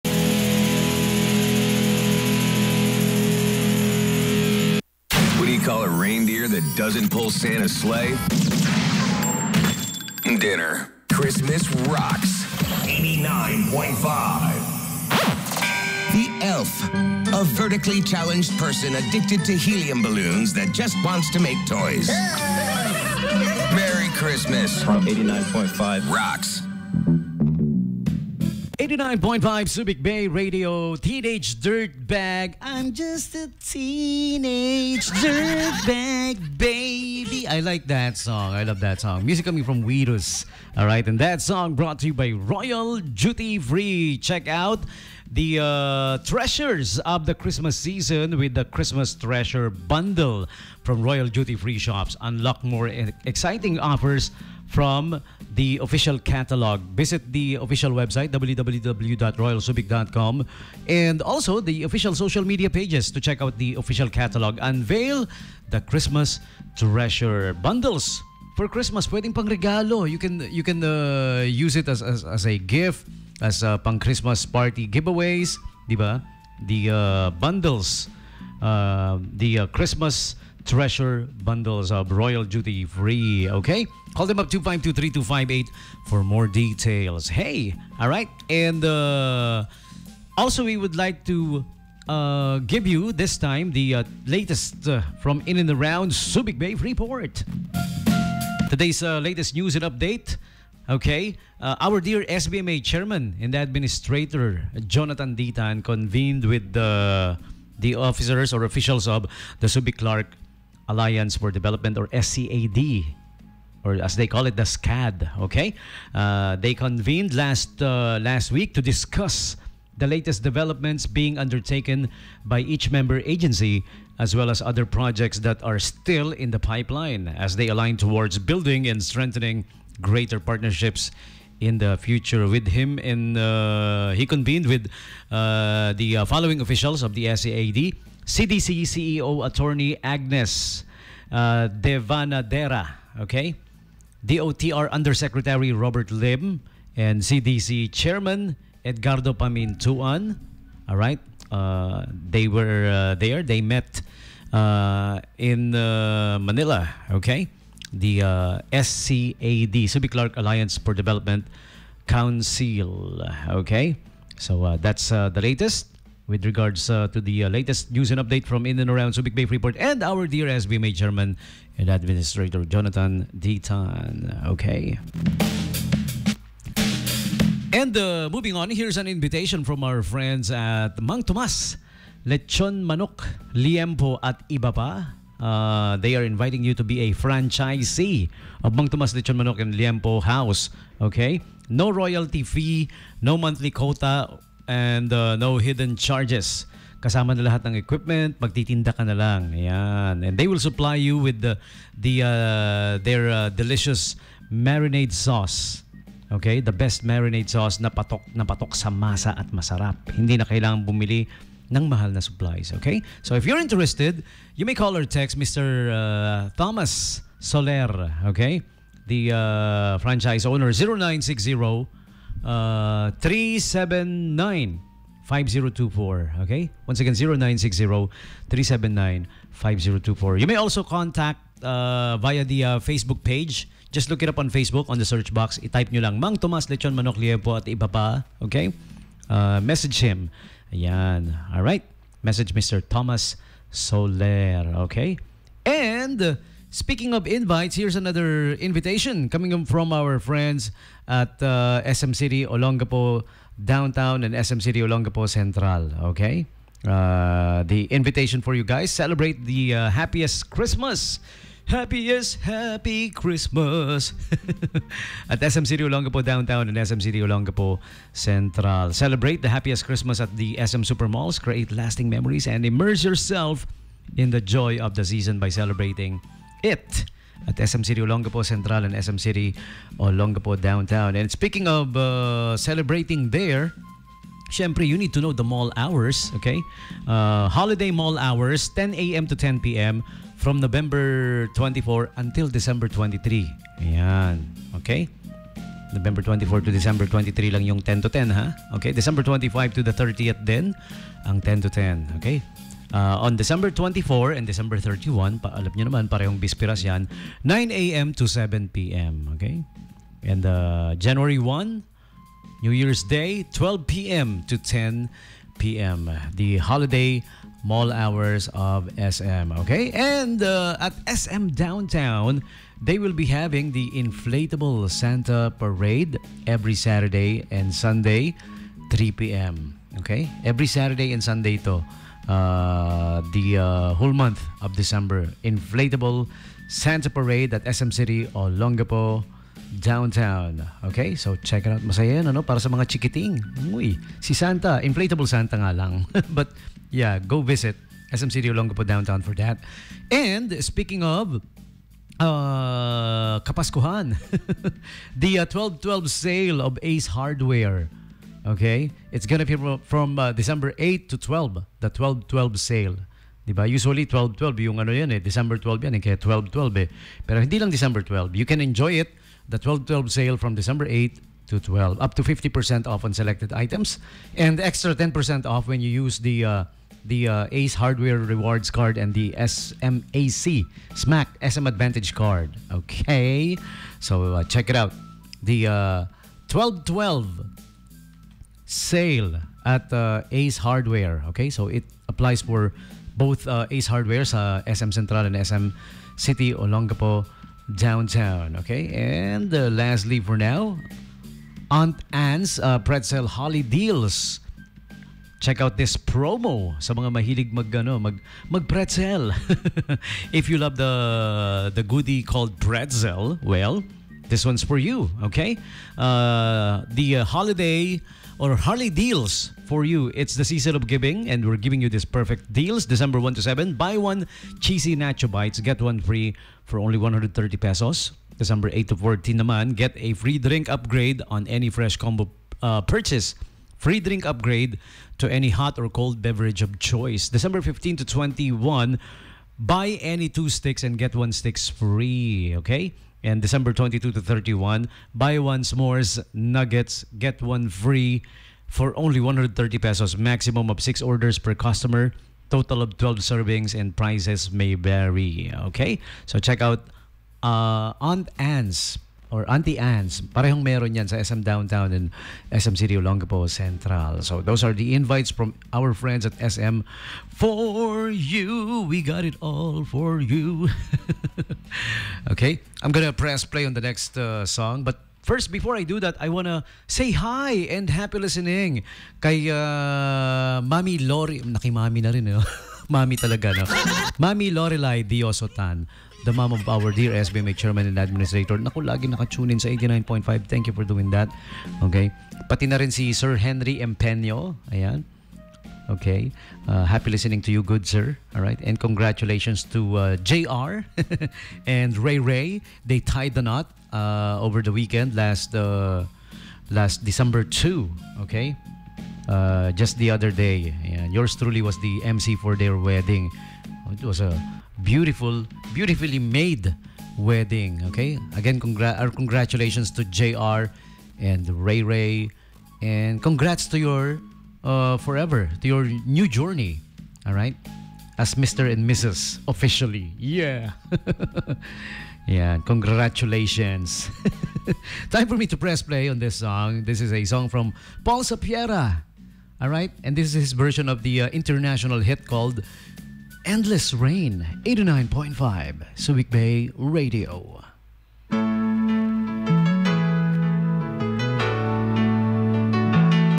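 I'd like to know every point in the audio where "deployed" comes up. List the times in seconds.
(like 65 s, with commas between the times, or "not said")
not said.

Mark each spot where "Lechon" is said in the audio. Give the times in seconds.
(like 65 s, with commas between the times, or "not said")
182 s, 189 s, 236 s.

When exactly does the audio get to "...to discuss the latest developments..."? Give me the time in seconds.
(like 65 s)
118 s.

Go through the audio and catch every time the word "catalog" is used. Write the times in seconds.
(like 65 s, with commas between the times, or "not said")
56 s, 64 s.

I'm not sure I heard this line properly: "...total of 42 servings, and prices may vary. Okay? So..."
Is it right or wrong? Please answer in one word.
wrong.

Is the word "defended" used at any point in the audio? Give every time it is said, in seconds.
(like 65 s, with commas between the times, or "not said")
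not said.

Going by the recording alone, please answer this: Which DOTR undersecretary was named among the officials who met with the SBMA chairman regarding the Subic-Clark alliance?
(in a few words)
Robert Lim.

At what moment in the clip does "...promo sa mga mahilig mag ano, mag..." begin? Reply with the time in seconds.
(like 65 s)
405 s.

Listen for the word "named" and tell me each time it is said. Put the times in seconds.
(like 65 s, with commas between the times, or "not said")
not said.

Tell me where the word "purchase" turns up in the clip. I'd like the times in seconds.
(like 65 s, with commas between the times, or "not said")
432 s.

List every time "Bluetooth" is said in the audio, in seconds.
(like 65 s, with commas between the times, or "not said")
not said.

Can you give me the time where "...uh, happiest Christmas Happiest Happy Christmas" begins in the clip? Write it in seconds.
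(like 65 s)
259 s.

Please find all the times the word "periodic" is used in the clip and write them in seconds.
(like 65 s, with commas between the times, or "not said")
not said.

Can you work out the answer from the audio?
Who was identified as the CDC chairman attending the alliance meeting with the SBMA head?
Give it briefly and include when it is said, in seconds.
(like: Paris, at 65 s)
Edgardo Pamintuan, at 148 s.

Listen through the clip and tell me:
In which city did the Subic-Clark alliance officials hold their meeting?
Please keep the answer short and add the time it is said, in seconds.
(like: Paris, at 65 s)
Manila, at 155 s.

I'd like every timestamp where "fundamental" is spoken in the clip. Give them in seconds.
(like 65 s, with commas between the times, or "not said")
not said.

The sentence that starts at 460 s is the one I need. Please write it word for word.
Parehong meron yan sa SM Downtown and SM City Olongapo Central.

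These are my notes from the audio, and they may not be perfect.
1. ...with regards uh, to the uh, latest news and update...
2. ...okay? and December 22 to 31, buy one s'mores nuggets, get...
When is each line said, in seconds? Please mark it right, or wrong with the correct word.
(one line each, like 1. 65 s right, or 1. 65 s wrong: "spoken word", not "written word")
1. 166 s right
2. 442 s right.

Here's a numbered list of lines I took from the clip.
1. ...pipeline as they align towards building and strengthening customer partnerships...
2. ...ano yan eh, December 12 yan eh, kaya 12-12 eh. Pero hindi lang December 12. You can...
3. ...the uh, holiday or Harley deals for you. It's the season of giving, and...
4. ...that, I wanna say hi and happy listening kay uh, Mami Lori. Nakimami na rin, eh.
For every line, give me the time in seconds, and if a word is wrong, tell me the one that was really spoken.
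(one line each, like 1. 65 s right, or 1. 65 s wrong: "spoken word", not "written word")
1. 126 s wrong: "greater", not "customer"
2. 364 s right
3. 416 s right
4. 476 s right.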